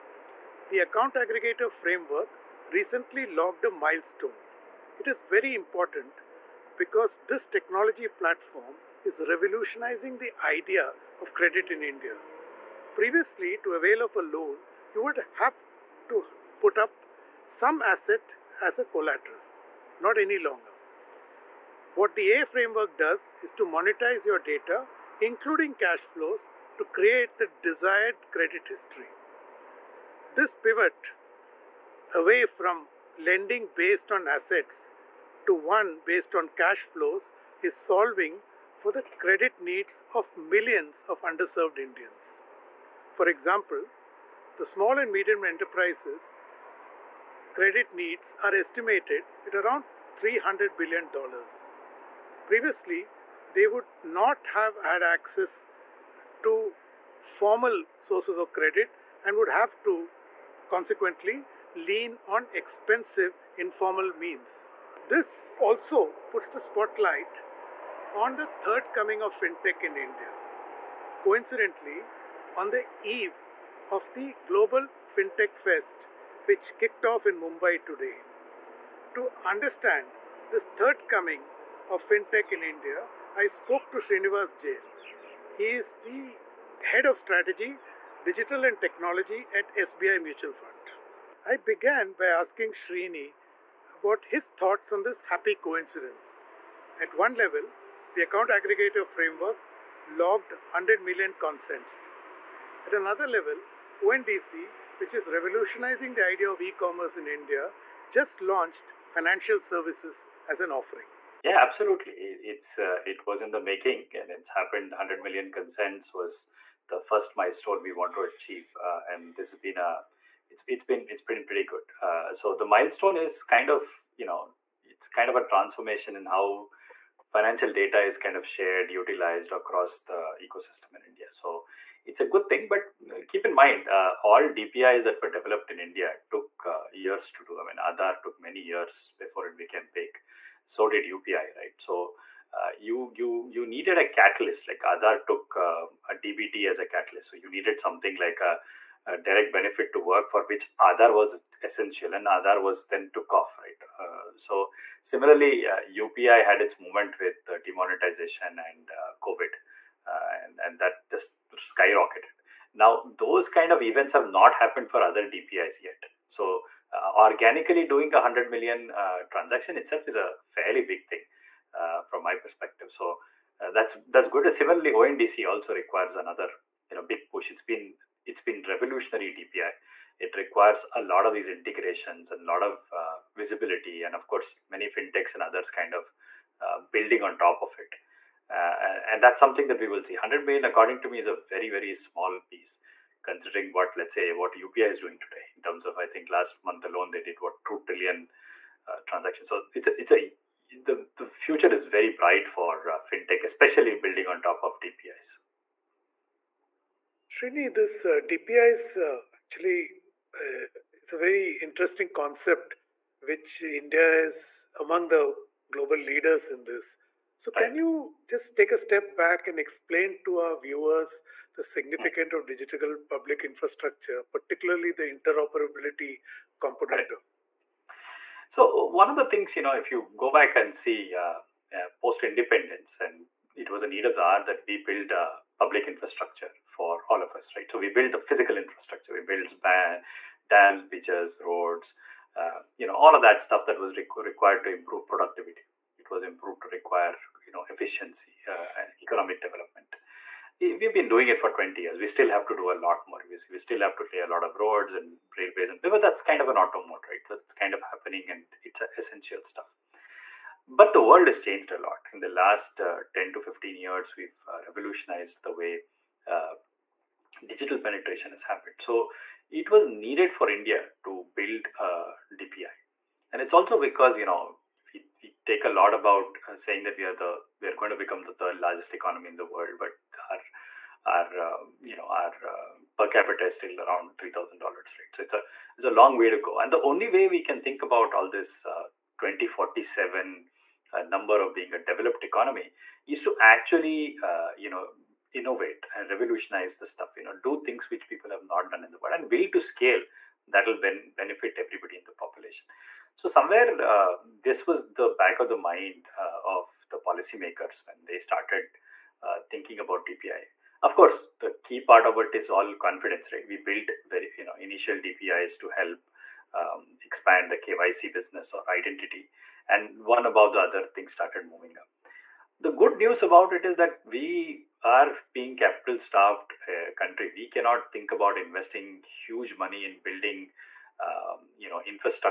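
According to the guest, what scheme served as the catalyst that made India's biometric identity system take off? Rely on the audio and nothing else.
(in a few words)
DBT.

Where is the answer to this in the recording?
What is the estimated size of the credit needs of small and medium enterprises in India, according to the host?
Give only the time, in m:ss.
0:50.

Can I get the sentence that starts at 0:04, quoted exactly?
It is very important because this technology platform is revolutionizing the idea of credit in India.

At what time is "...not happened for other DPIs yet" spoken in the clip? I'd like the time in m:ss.
2:44.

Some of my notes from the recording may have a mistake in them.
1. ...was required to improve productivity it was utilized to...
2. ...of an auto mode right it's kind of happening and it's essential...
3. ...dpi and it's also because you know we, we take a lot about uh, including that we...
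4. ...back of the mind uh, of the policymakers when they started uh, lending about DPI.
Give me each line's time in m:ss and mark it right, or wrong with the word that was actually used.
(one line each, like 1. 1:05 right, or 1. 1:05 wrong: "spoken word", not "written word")
1. 4:03 wrong: "improved", not "utilized"
2. 4:16 right
3. 4:32 wrong: "saying", not "including"
4. 5:05 wrong: "thinking", not "lending".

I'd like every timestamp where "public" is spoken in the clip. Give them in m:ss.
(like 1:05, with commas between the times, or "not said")
3:43, 3:55.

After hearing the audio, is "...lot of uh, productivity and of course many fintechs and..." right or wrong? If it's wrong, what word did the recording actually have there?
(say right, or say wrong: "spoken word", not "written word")
wrong: "visibility", not "productivity".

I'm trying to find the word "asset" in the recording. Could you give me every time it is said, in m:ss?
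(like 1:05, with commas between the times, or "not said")
0:17, 0:34.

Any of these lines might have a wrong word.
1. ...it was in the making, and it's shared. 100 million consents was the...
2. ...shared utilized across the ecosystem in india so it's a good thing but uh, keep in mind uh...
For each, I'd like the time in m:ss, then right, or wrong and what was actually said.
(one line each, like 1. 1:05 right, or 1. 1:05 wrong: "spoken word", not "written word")
1. 1:53 wrong: "happened", not "shared"
2. 2:08 right.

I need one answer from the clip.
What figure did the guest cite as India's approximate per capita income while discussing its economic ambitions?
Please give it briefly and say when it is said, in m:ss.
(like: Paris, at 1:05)
$3,000, at 4:44.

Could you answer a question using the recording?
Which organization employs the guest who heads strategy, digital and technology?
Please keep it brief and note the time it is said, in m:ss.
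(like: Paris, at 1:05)
SBI Mutual Fund, at 1:29.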